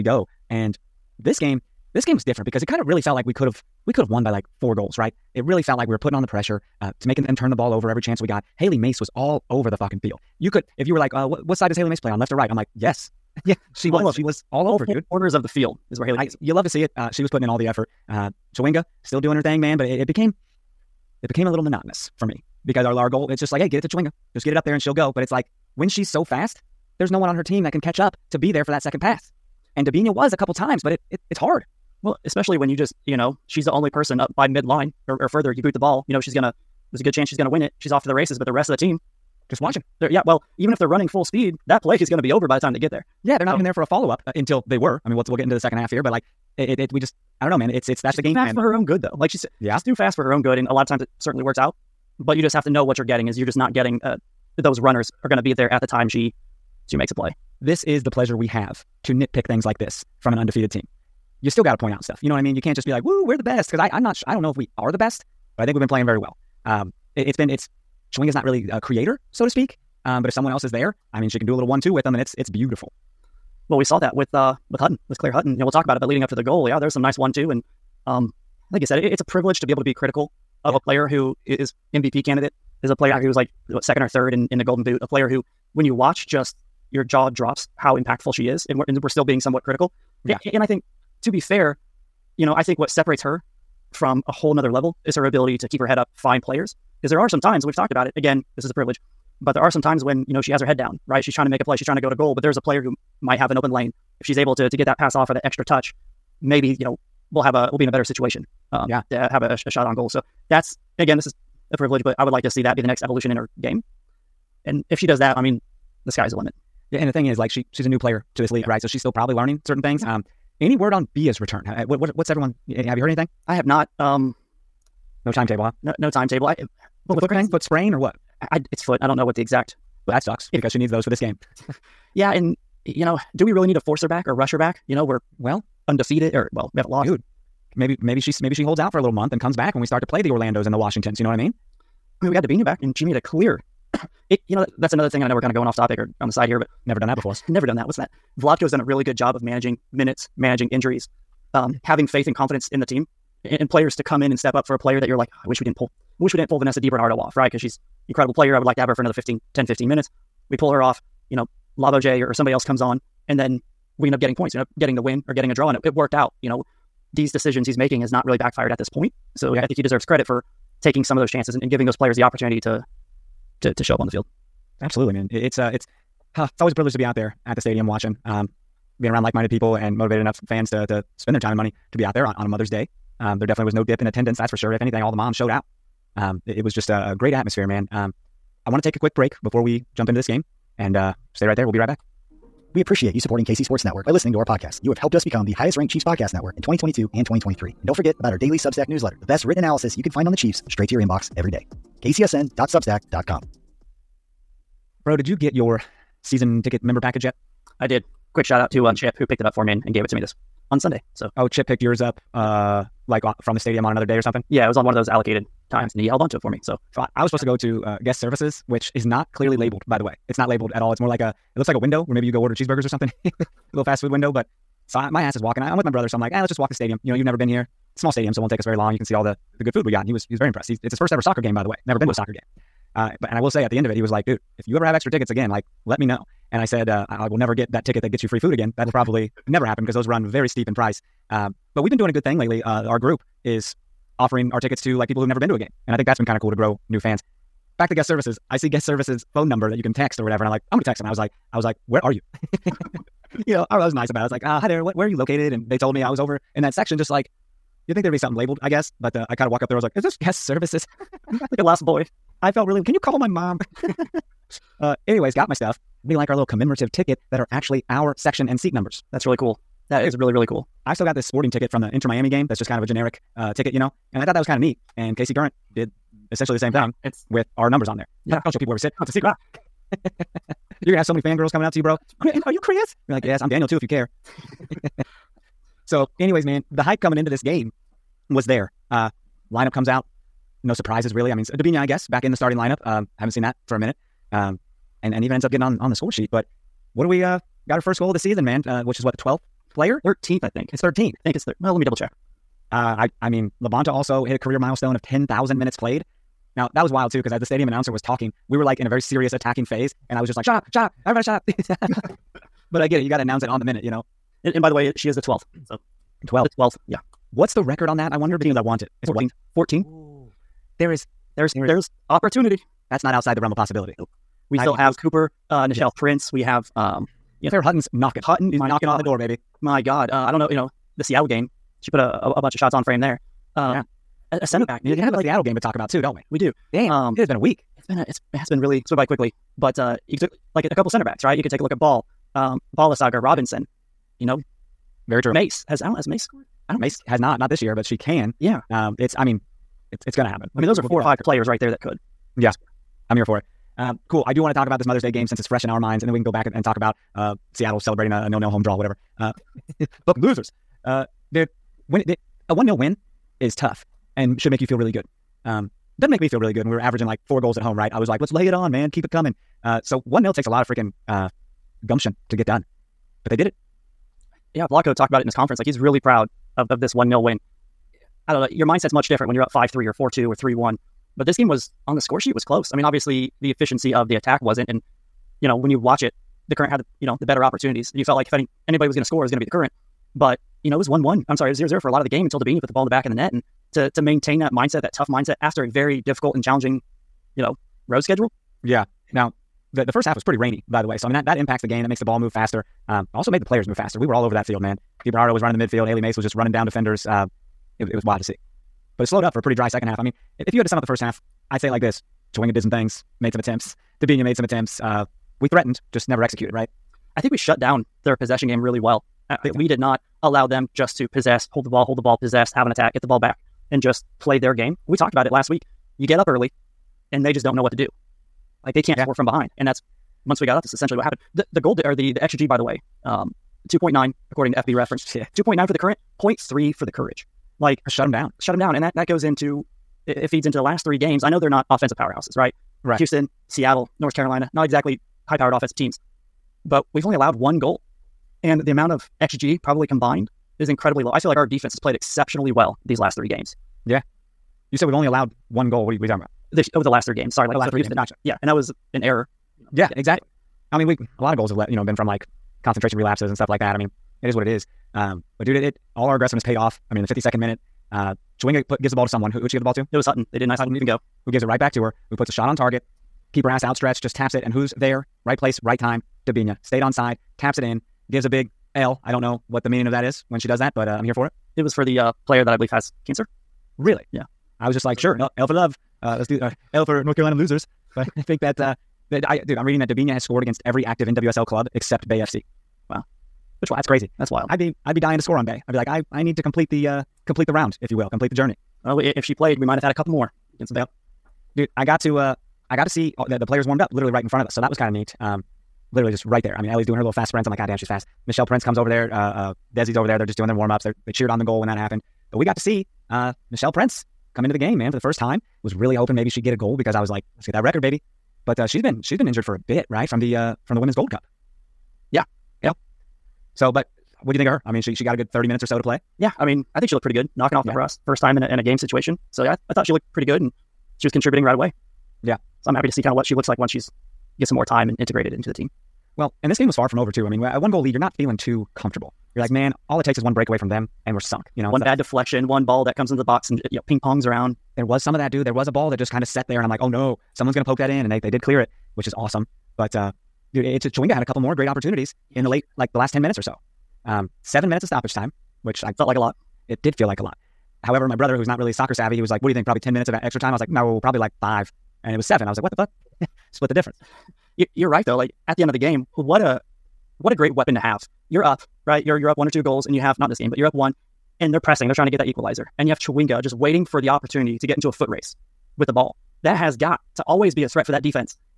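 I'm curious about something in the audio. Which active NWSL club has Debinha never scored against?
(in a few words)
Bay FC.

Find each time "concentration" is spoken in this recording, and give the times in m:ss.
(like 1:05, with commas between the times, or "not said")
7:42.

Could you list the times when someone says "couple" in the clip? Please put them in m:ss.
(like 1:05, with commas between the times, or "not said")
0:30, 5:40, 8:19, 9:11.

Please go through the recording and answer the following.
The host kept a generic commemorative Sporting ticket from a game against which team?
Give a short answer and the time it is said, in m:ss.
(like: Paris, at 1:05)
Inter Miami, at 4:31.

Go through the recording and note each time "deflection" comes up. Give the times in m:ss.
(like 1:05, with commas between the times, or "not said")
9:01.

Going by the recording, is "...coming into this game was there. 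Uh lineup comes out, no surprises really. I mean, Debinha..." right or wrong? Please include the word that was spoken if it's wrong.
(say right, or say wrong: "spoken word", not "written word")
right.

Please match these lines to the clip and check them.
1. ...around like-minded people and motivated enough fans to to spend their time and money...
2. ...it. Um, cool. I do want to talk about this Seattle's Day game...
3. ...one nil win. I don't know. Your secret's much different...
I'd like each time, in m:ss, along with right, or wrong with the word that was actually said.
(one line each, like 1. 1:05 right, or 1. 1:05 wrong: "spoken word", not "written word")
1. 2:59 right
2. 5:53 wrong: "Mother", not "Seattle"
3. 6:16 wrong: "mindset", not "secret".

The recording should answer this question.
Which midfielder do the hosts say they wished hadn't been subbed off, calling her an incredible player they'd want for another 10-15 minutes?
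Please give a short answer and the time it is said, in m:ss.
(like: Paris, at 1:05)
Vanessa DiBernardo, at 2:36.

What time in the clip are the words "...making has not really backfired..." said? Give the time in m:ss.
2:47.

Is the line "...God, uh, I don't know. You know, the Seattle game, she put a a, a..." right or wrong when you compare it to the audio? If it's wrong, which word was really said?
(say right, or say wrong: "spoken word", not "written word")
right.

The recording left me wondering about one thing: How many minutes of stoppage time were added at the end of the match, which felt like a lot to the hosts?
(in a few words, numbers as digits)
7.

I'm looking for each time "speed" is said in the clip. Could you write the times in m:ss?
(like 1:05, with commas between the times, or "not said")
0:41.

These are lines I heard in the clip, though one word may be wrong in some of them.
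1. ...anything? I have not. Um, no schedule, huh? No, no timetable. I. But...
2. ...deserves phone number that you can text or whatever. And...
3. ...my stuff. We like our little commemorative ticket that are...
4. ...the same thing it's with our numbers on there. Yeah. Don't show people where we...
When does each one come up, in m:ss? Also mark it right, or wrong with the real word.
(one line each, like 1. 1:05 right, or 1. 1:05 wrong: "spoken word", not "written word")
1. 2:03 wrong: "timetable", not "schedule"
2. 4:08 wrong: "services", not "deserves"
3. 4:25 right
4. 4:36 right.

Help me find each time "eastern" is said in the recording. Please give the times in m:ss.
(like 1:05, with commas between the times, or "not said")
not said.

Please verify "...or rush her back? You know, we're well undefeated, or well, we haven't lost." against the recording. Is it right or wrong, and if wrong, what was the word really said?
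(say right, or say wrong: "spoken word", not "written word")
right.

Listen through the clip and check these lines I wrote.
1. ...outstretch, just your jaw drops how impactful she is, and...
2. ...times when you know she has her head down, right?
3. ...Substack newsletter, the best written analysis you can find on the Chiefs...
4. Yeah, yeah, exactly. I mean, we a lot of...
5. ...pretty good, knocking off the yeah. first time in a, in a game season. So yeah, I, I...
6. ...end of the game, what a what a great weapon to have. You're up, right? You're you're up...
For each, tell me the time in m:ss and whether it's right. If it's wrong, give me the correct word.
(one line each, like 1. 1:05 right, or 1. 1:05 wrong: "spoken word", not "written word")
1. 1:25 wrong: "watch", not "outstretch"
2. 1:39 right
3. 3:18 right
4. 7:39 right
5. 8:47 wrong: "situation", not "season"
6. 9:25 right.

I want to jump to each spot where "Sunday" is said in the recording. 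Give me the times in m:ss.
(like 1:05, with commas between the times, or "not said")
3:30.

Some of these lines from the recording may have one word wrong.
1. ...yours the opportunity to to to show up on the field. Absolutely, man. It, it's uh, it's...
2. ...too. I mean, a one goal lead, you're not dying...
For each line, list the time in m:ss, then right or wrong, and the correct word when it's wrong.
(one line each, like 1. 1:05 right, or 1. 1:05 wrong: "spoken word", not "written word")
1. 2:51 wrong: "players", not "yours"
2. 8:57 wrong: "feeling", not "dying".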